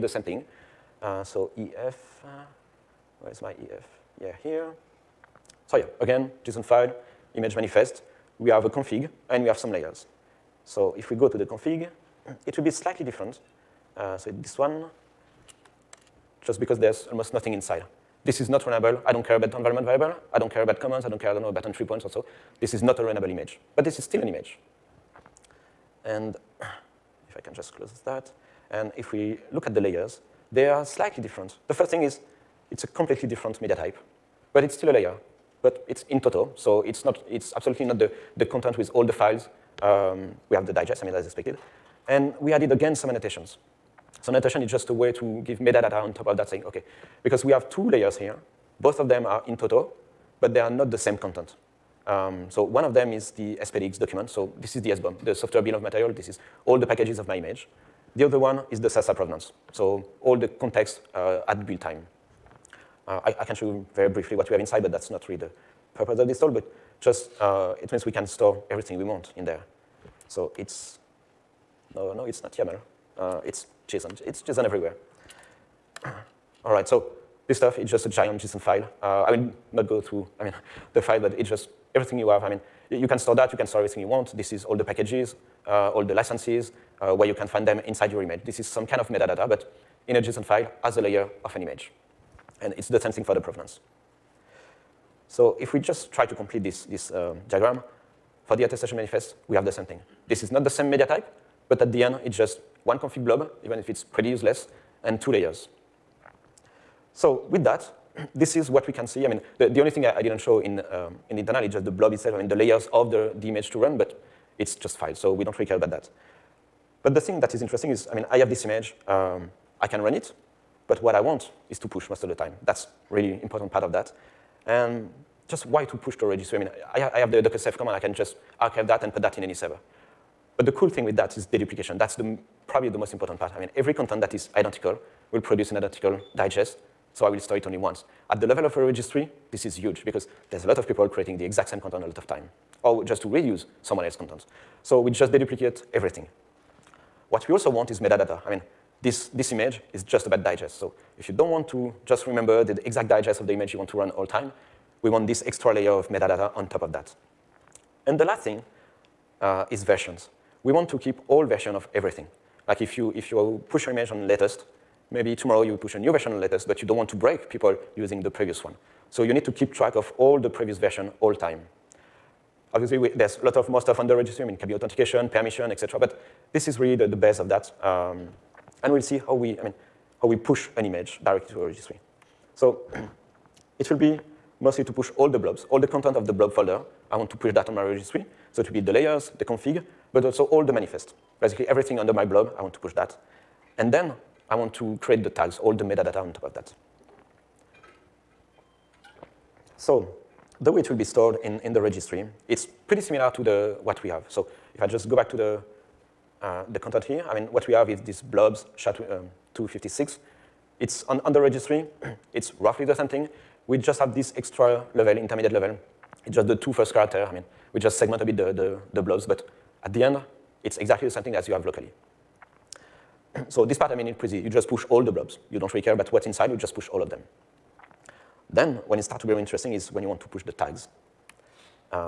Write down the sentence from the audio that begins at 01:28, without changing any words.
This is some kind of metadata, but in a JSON file as a layer of an image.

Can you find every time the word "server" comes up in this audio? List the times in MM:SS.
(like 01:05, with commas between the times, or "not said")
02:09.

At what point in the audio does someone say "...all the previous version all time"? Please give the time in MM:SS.
02:50.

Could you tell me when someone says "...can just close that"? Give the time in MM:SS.
00:27.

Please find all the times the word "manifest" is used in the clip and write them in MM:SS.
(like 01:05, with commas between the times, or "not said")
00:07, 01:38, 03:10.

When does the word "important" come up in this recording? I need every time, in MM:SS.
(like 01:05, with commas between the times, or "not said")
02:03, 02:13.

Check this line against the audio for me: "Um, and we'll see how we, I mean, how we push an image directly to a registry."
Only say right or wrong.
right.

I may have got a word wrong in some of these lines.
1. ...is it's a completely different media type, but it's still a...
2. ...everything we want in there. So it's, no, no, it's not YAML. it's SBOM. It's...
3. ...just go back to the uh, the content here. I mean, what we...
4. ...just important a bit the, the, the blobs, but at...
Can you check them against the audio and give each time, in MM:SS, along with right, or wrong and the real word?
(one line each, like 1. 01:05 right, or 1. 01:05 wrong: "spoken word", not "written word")
1. 00:32 right
2. 01:08 wrong: "JSON", not "SBOM"
3. 03:24 right
4. 03:37 wrong: "segment", not "important".